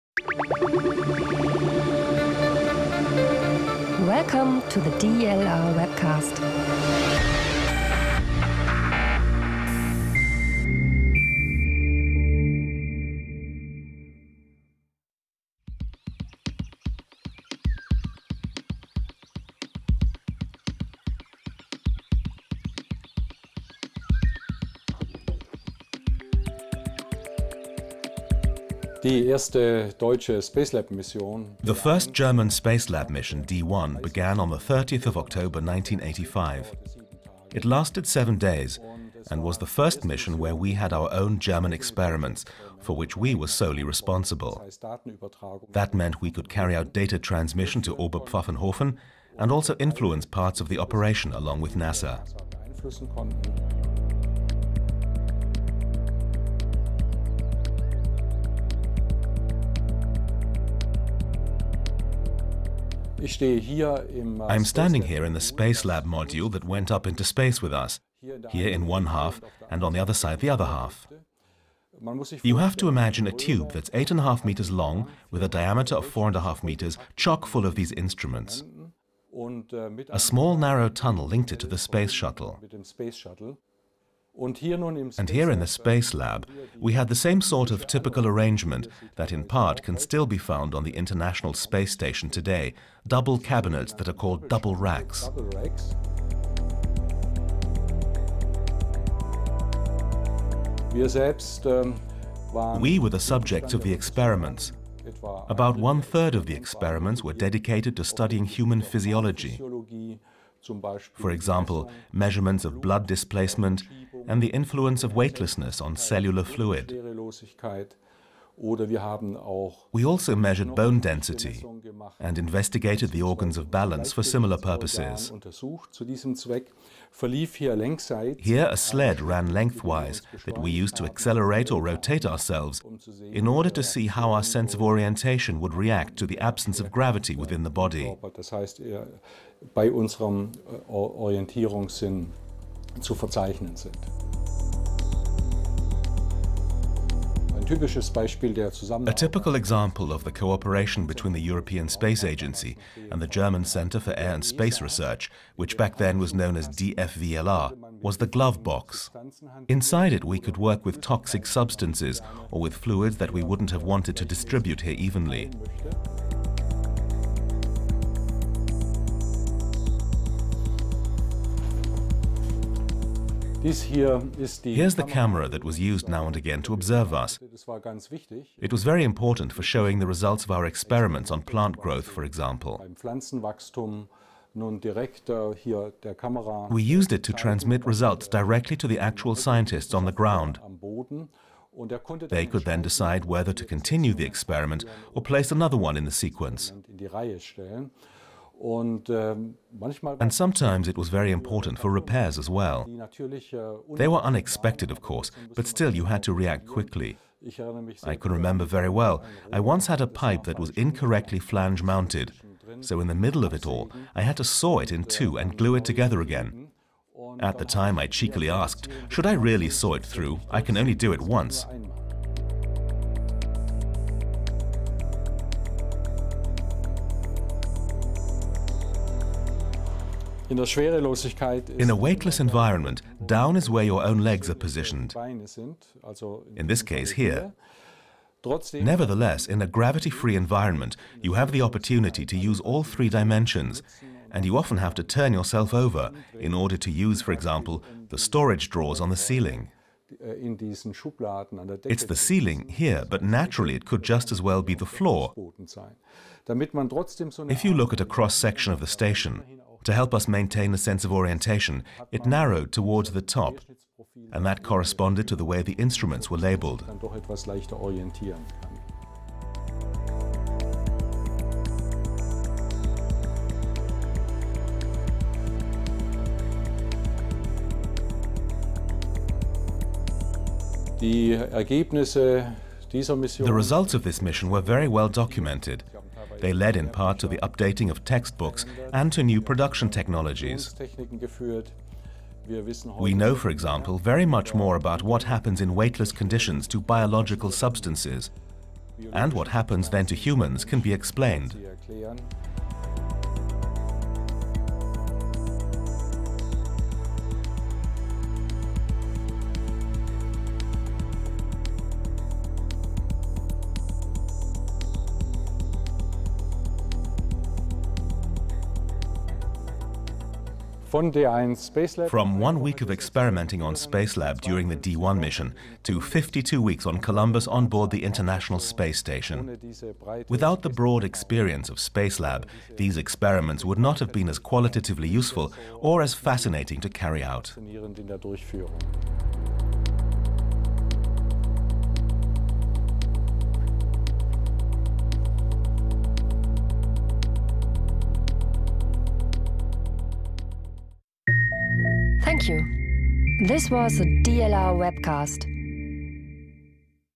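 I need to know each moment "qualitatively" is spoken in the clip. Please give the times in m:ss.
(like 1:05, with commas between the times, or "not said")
5:34.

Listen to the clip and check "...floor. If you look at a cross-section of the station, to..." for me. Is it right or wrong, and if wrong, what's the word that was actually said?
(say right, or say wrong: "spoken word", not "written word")
right.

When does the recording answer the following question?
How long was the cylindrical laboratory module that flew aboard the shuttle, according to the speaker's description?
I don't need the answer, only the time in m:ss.
1:13.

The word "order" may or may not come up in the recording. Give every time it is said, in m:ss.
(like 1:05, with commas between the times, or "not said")
2:13, 4:06.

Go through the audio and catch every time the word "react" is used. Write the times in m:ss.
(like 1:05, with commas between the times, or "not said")
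2:15, 3:26.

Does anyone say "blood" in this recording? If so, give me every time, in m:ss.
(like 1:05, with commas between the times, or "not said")
1:52.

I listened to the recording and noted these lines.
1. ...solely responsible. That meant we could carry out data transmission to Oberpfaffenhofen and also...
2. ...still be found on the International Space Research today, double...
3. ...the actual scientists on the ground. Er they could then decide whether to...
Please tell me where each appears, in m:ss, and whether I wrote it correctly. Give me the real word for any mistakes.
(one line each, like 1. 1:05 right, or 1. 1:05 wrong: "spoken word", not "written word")
1. 0:43 right
2. 1:29 wrong: "Station", not "Research"
3. 3:08 right.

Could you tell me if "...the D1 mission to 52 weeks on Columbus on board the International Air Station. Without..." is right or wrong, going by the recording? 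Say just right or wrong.
wrong.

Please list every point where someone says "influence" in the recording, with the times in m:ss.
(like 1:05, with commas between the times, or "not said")
0:49, 1:54.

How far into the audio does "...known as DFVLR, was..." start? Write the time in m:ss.
2:36.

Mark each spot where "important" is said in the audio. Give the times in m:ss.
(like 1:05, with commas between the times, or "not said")
2:59, 3:21.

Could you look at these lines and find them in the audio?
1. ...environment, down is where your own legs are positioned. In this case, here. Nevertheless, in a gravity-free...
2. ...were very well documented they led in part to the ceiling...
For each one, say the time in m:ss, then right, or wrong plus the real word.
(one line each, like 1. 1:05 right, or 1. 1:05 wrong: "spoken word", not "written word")
1. 3:52 right
2. 4:44 wrong: "updating", not "ceiling".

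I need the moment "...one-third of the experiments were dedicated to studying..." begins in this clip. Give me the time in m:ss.
1:45.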